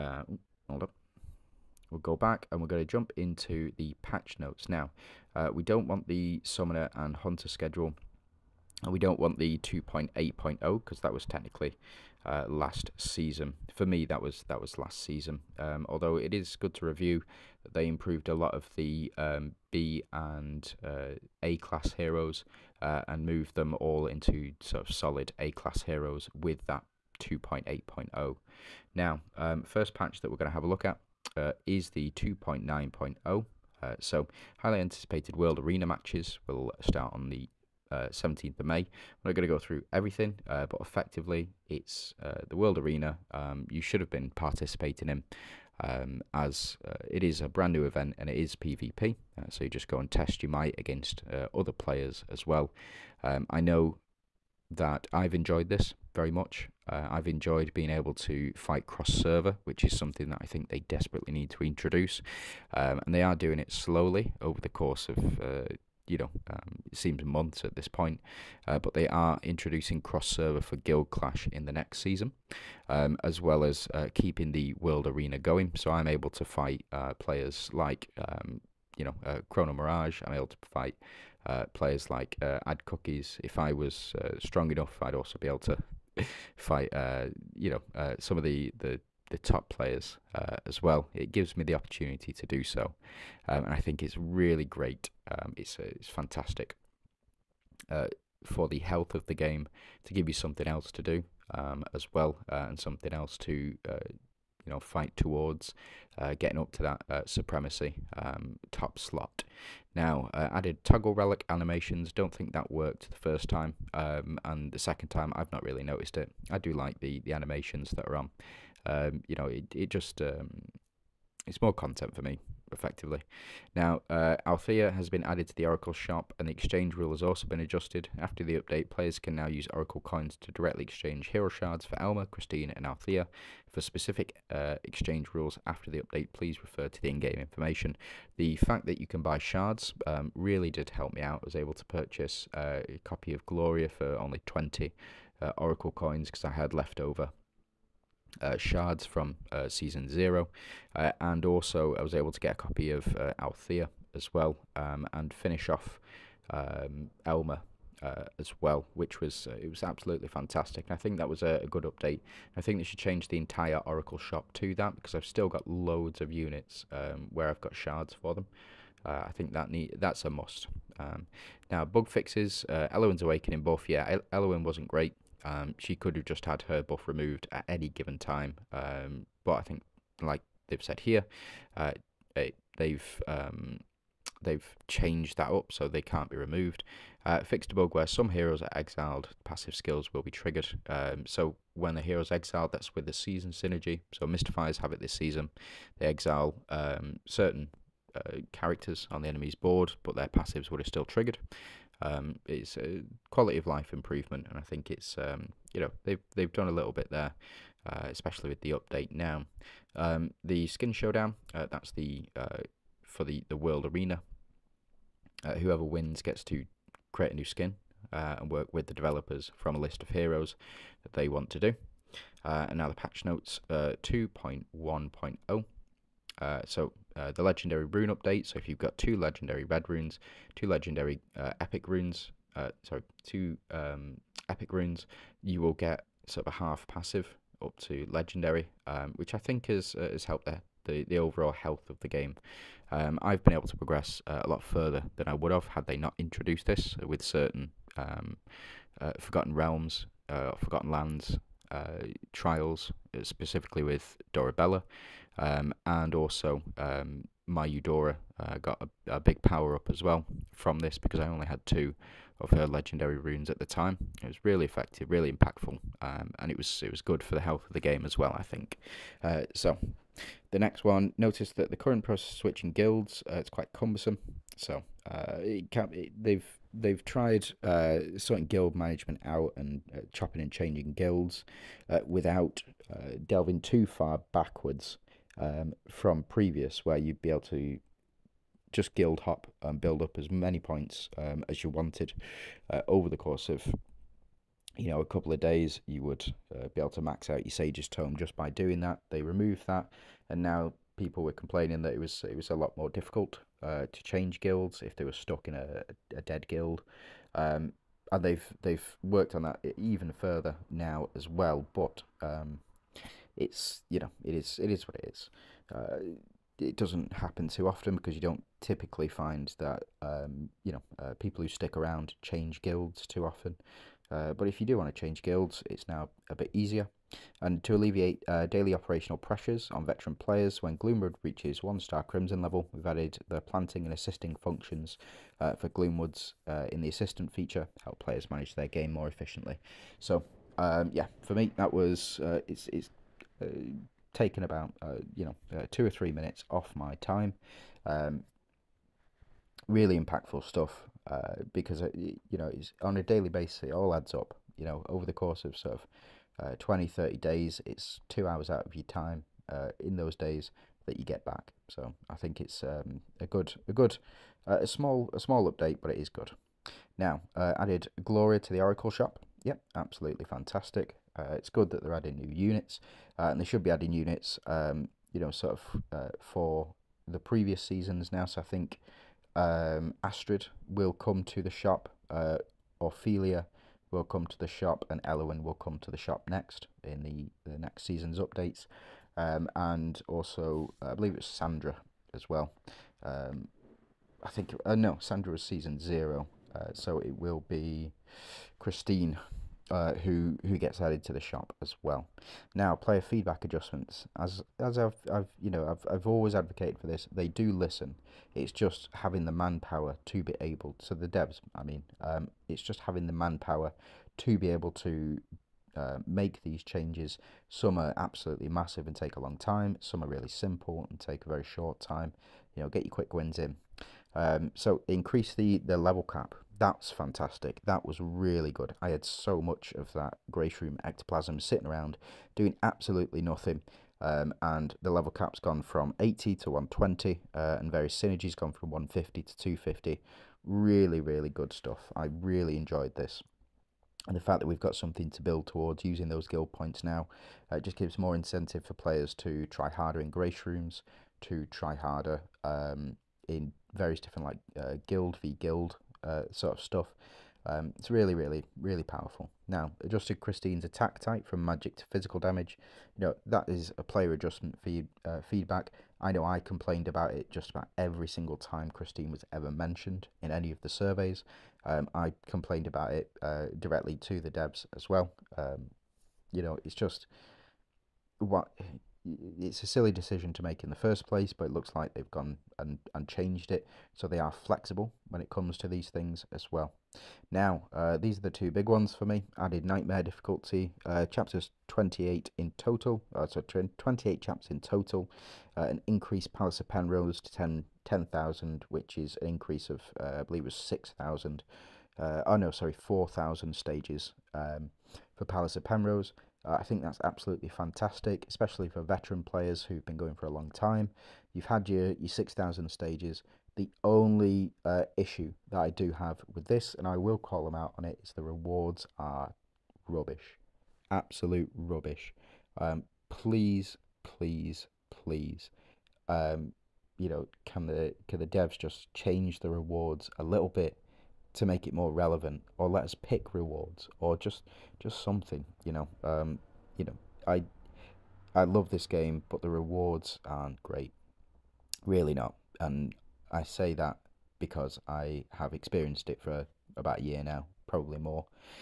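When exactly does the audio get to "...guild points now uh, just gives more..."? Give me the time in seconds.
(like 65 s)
446 s.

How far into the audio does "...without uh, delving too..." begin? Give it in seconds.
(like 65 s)
282 s.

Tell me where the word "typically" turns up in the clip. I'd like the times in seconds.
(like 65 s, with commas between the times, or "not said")
318 s.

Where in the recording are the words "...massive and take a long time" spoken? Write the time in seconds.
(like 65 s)
418 s.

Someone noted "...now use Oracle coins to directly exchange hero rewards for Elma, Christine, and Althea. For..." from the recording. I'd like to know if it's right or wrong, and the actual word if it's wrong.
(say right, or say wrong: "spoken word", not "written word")
wrong: "shards", not "rewards".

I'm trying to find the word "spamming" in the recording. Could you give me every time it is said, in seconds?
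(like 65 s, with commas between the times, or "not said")
not said.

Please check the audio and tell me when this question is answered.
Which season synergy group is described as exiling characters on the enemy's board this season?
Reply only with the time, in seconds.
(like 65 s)
194 s.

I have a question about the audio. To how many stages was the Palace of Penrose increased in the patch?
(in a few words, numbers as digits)
10,000.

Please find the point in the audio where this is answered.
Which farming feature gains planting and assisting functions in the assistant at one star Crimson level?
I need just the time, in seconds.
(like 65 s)
330 s.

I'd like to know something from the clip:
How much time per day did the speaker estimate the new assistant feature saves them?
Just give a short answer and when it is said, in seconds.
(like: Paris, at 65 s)
2 or 3 minutes, at 345 s.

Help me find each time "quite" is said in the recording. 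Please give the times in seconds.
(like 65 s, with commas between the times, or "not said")
273 s.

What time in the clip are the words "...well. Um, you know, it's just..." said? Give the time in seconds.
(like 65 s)
474 s.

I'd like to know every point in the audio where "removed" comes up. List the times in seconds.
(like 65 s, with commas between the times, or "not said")
177 s, 186 s, 299 s.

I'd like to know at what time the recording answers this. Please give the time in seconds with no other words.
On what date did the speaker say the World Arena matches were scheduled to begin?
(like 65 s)
38 s.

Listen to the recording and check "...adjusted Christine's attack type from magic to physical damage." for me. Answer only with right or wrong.
right.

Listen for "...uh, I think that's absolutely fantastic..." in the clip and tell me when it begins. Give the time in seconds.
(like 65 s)
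506 s.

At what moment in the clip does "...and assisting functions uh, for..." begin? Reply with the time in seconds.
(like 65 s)
333 s.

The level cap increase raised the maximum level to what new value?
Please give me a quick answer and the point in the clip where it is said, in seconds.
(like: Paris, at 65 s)
120, at 436 s.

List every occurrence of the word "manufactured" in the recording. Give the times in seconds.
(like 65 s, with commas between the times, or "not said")
not said.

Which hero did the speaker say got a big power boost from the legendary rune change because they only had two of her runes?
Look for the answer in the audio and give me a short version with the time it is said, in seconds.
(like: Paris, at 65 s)
Eudora, at 257 s.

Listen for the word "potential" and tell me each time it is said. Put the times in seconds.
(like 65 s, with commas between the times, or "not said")
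not said.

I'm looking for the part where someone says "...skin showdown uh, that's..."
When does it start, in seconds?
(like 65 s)
210 s.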